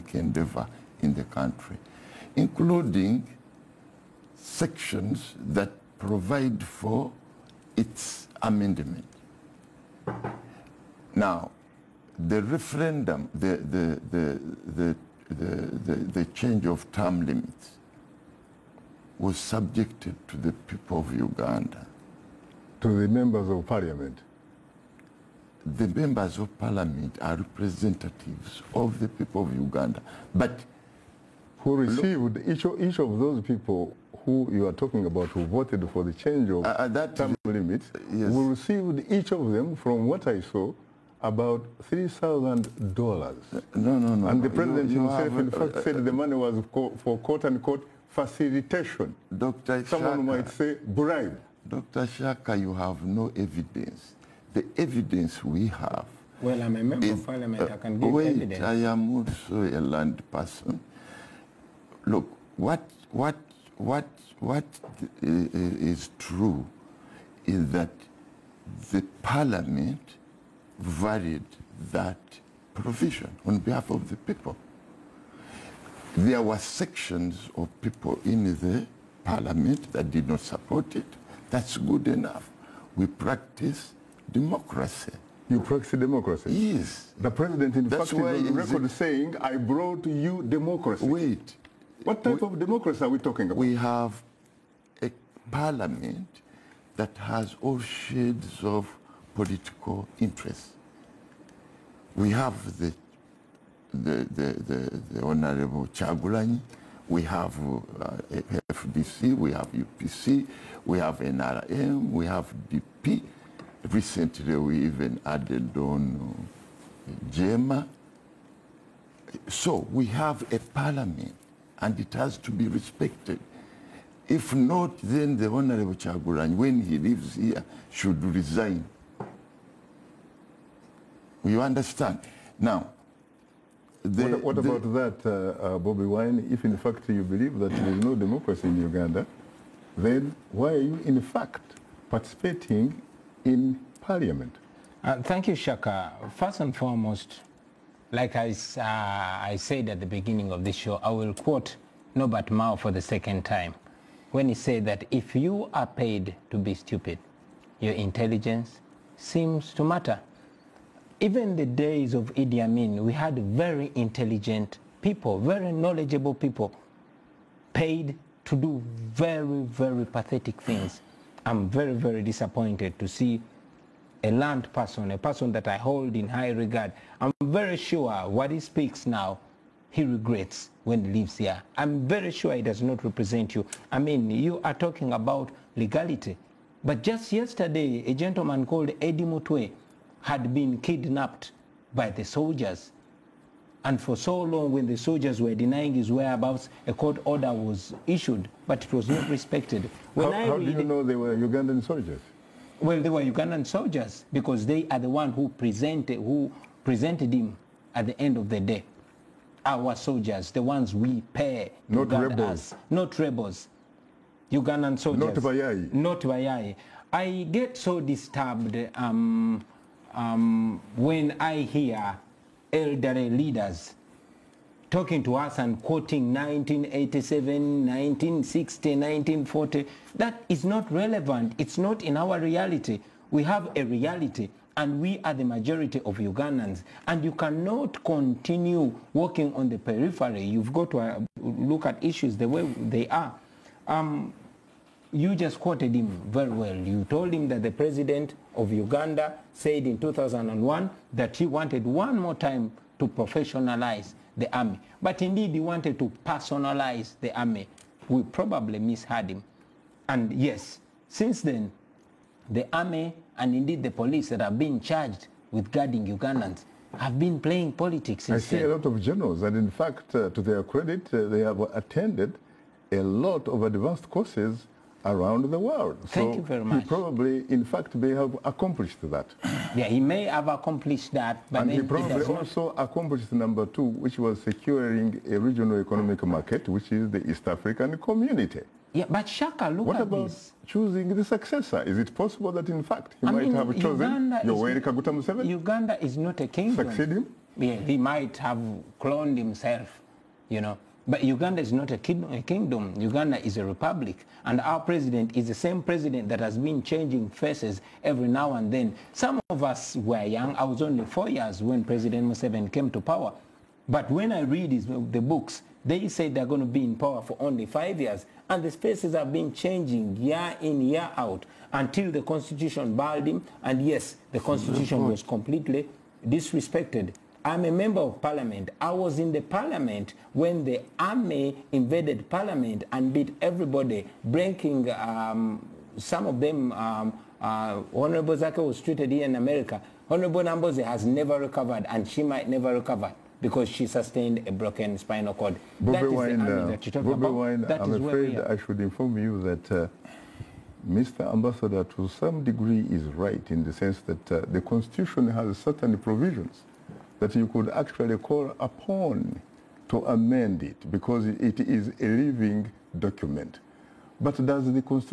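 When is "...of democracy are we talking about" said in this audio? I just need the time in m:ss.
1:32.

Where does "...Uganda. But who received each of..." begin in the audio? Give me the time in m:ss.
0:29.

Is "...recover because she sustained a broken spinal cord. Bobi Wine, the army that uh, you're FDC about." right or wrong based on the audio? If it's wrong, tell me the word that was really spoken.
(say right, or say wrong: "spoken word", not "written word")
wrong: "Bobi", not "FDC".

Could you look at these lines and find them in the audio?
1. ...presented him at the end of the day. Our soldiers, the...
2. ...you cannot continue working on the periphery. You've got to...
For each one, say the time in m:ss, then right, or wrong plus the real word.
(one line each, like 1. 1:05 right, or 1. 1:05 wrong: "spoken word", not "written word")
1. 3:26 right
2. 3:57 right.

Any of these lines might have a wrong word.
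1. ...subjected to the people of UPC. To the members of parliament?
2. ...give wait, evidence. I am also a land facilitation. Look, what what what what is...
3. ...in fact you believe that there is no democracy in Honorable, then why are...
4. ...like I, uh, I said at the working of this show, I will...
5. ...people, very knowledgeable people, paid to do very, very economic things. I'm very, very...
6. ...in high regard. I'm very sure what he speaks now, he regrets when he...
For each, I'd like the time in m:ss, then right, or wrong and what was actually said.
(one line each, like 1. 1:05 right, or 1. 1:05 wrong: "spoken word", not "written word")
1. 0:19 wrong: "Uganda", not "UPC"
2. 0:57 wrong: "person", not "facilitation"
3. 2:16 wrong: "Uganda", not "Honorable"
4. 2:28 wrong: "beginning", not "working"
5. 2:45 wrong: "pathetic", not "economic"
6. 2:56 right.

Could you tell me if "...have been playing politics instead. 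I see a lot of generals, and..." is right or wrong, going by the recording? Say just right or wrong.
right.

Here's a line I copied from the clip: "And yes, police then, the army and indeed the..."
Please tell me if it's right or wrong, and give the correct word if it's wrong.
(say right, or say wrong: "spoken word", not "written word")
wrong: "since", not "police".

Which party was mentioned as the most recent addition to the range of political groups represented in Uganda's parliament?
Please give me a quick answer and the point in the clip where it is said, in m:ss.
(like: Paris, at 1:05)
JEEMA, at 1:57.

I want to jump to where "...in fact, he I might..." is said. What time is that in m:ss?
4:52.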